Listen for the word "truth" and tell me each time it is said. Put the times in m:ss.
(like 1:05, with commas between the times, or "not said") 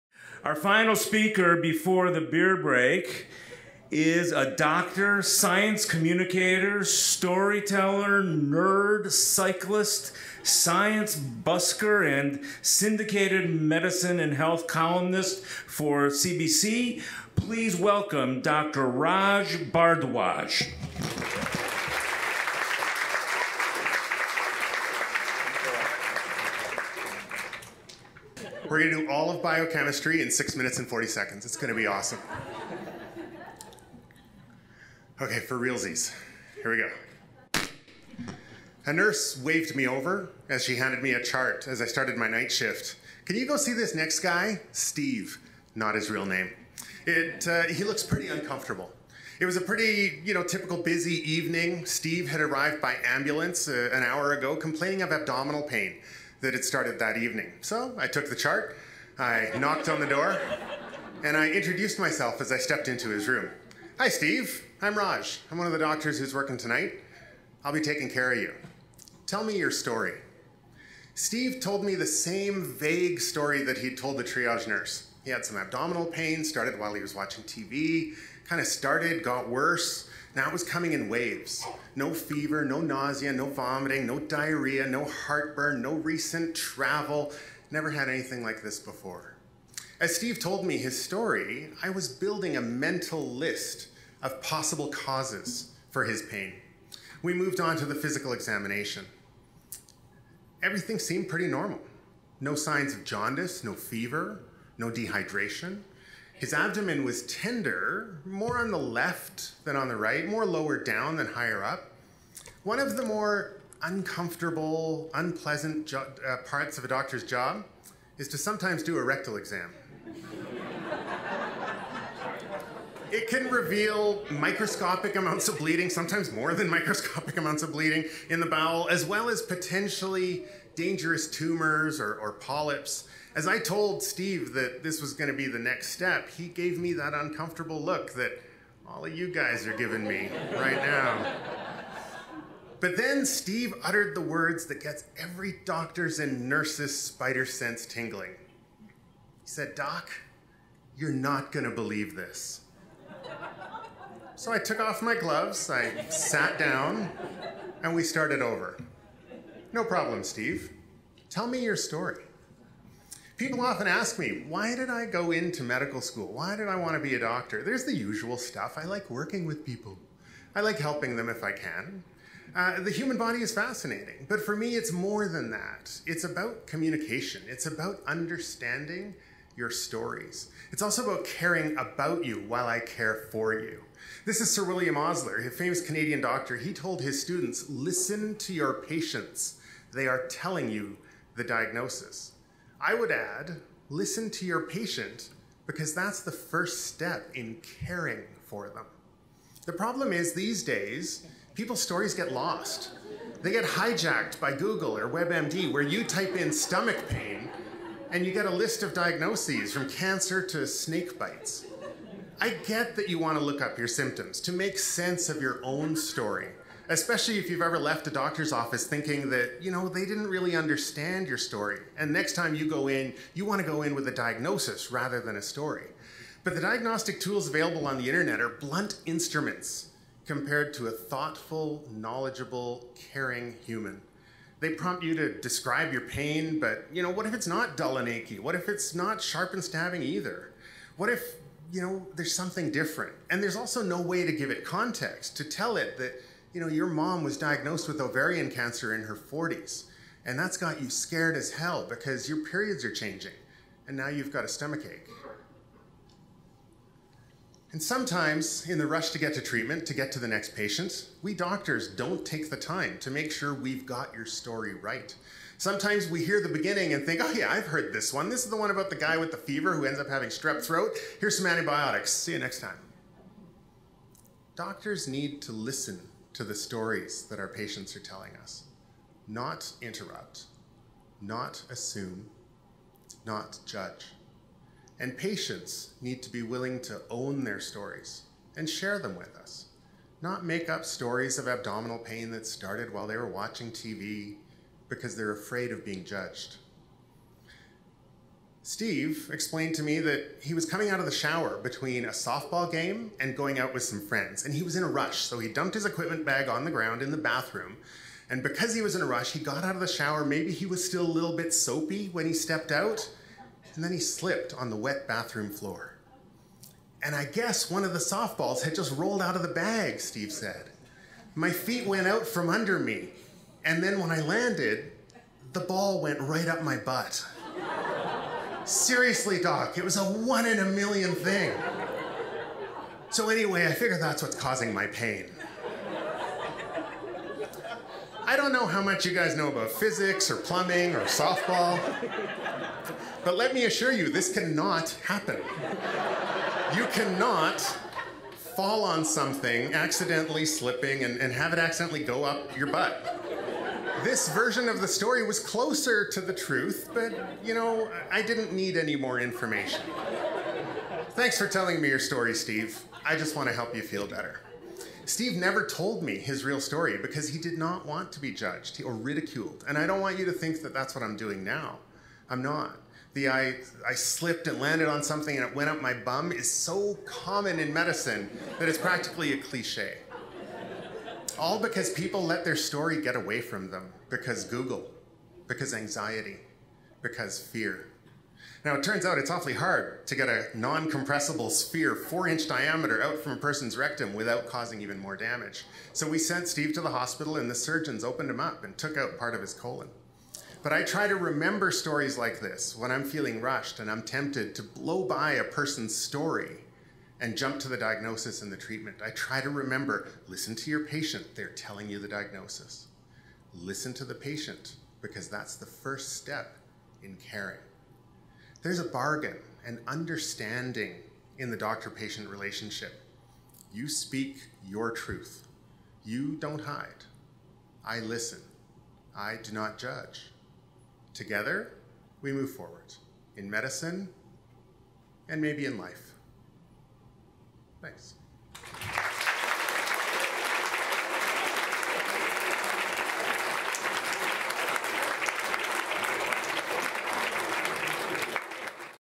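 5:56, 7:04.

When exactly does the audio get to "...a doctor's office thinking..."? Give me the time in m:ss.
3:38.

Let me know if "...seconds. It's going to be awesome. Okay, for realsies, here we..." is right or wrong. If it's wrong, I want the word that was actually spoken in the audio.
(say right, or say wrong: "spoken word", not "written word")
right.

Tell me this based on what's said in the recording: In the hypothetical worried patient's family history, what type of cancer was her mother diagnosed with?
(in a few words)
Ovarian cancer.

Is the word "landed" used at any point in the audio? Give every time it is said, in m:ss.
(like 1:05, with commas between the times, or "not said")
5:24, 6:14.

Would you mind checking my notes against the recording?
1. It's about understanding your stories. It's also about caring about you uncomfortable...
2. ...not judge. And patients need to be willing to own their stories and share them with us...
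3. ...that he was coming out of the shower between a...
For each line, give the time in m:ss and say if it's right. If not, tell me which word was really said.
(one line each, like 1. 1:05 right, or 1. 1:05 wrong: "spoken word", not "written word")
1. 2:57 wrong: "while", not "uncomfortable"
2. 4:43 right
3. 4:59 right.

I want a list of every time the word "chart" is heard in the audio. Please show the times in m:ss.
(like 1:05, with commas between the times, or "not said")
0:41, 0:58.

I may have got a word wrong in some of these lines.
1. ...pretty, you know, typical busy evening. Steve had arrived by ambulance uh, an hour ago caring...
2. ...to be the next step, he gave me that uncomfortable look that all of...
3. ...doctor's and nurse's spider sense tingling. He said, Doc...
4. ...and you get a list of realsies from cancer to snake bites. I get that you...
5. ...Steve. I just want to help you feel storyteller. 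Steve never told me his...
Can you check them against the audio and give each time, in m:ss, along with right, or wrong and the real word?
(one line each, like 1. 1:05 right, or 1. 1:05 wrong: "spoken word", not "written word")
1. 0:49 wrong: "complaining", not "caring"
2. 2:15 right
3. 2:25 right
4. 3:28 wrong: "diagnoses", not "realsies"
5. 6:02 wrong: "better", not "storyteller".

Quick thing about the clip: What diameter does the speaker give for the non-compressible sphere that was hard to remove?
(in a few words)
4 inches.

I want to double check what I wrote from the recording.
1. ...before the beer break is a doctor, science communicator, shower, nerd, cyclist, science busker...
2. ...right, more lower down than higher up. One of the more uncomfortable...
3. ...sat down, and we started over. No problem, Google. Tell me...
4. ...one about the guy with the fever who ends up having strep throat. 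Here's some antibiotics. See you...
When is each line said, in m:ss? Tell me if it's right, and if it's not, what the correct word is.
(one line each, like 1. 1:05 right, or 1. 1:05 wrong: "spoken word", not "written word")
1. 0:01 wrong: "storyteller", not "shower"
2. 1:49 right
3. 2:36 wrong: "Steve", not "Google"
4. 4:28 right.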